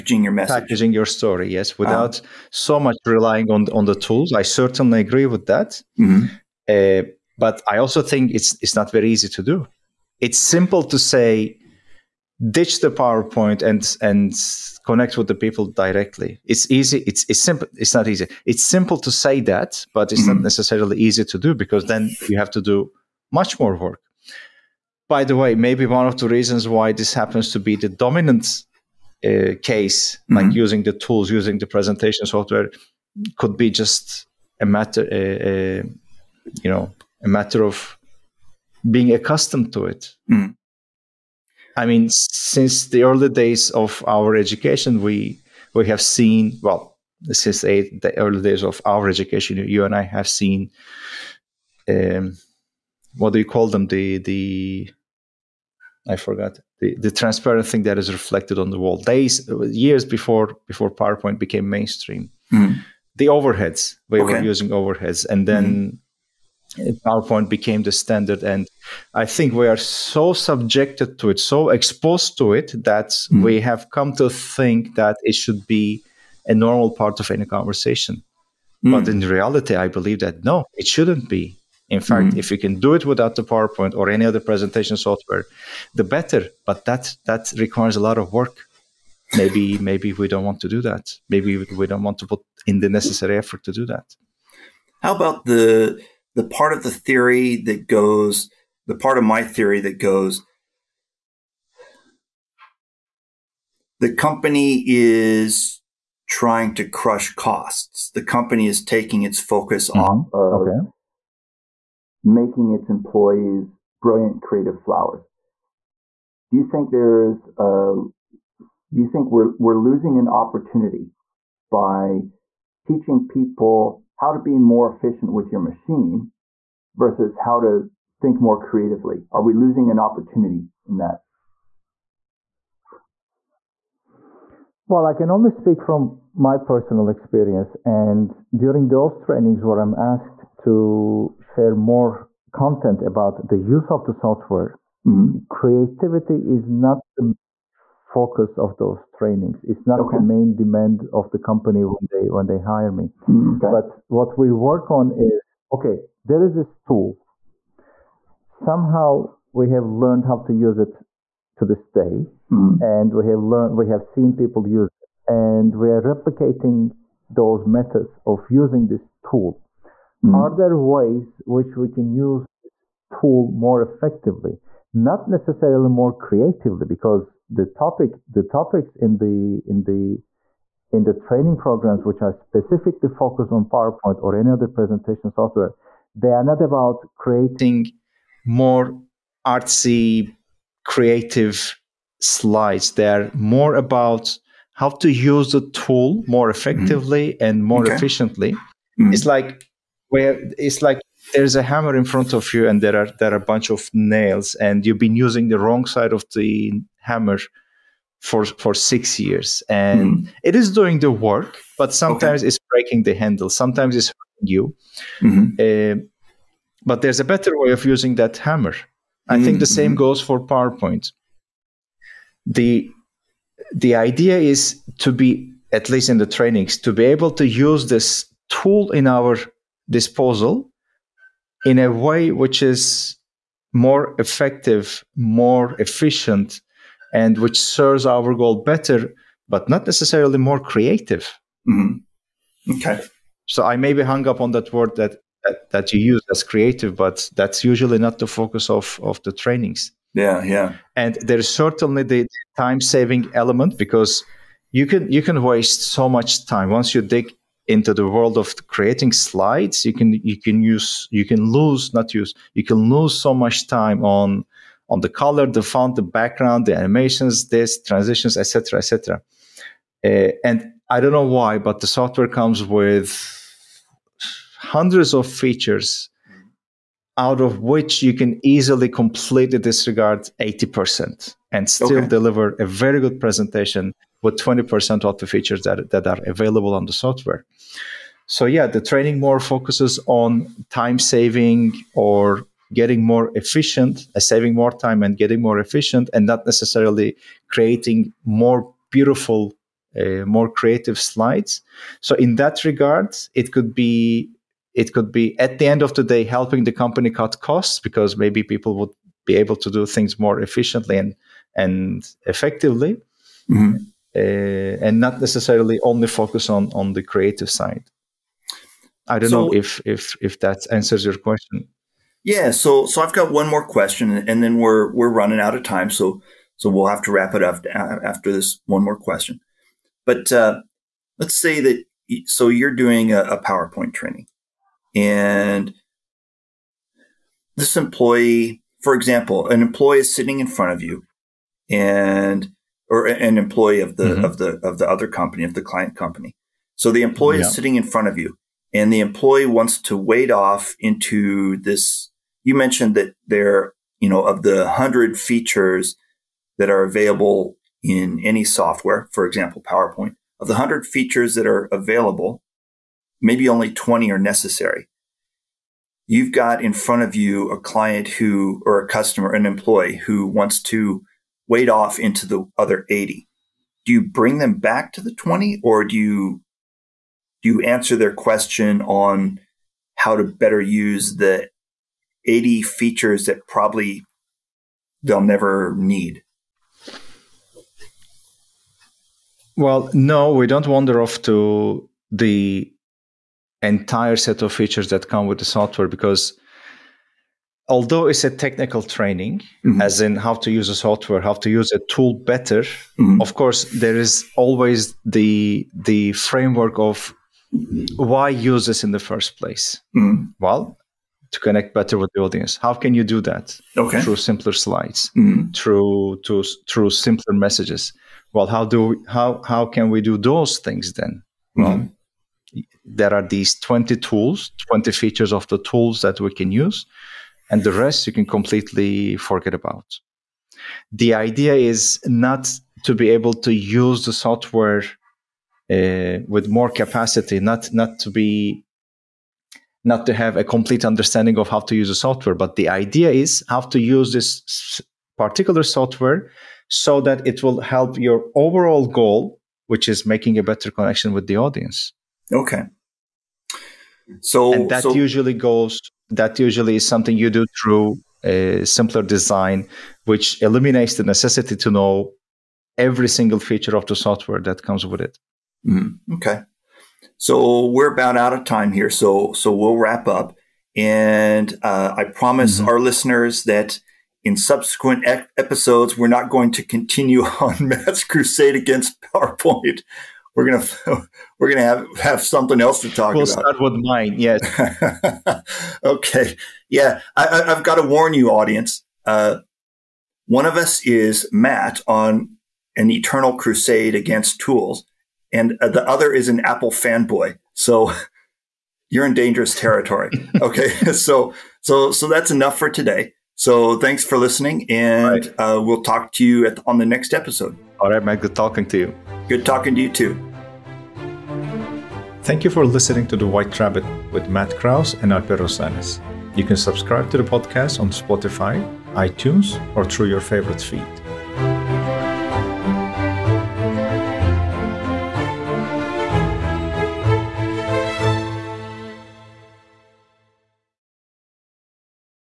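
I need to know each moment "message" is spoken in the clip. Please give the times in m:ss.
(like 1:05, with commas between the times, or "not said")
0:00, 6:57.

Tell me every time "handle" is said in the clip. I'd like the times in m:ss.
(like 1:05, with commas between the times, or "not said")
3:33.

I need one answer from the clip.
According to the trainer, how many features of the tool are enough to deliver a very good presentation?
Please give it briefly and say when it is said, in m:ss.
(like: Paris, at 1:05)
20, at 7:04.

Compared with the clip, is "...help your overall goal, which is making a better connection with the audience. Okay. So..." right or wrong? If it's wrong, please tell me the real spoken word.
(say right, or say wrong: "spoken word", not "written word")
right.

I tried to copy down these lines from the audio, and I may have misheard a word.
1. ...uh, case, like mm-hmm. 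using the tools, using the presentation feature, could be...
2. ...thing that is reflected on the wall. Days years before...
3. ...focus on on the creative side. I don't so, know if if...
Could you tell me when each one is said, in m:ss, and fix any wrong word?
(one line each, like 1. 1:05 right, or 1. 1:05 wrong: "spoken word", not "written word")
1. 0:29 wrong: "software", not "feature"
2. 0:57 right
3. 5:16 right.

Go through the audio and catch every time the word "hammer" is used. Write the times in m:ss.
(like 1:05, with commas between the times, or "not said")
3:21, 3:27, 3:38.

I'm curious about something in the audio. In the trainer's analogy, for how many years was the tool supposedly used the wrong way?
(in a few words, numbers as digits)
6.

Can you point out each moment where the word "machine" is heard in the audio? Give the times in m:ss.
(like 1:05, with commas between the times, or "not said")
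2:05.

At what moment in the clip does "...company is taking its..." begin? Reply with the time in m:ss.
1:48.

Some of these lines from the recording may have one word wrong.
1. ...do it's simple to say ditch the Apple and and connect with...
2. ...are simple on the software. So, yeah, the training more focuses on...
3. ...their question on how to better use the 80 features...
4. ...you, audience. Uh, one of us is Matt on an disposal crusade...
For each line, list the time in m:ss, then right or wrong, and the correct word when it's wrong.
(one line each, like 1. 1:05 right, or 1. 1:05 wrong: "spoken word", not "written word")
1. 0:09 wrong: "PowerPoint", not "Apple"
2. 4:46 wrong: "available", not "simple"
3. 6:17 right
4. 8:08 wrong: "eternal", not "disposal".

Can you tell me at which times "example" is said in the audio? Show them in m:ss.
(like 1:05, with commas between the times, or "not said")
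5:38, 5:59.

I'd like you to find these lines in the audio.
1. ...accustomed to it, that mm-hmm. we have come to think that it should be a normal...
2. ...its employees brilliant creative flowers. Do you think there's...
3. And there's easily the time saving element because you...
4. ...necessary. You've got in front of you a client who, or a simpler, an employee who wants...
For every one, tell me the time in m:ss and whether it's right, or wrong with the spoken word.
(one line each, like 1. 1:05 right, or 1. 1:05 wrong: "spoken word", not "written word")
1. 1:11 wrong: "exposed", not "accustomed"
2. 1:52 right
3. 4:10 wrong: "certainly", not "easily"
4. 6:04 wrong: "customer", not "simpler".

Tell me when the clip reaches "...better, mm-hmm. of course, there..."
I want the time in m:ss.
6:42.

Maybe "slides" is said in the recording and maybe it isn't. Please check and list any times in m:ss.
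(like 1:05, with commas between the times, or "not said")
3:12, 4:19, 5:00, 6:54.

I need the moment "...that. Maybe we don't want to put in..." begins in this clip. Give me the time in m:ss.
1:30.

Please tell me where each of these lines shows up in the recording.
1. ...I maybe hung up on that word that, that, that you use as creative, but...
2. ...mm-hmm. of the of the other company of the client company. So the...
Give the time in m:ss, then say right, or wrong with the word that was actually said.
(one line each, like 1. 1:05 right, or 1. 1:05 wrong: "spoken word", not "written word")
1. 4:03 right
2. 5:44 right.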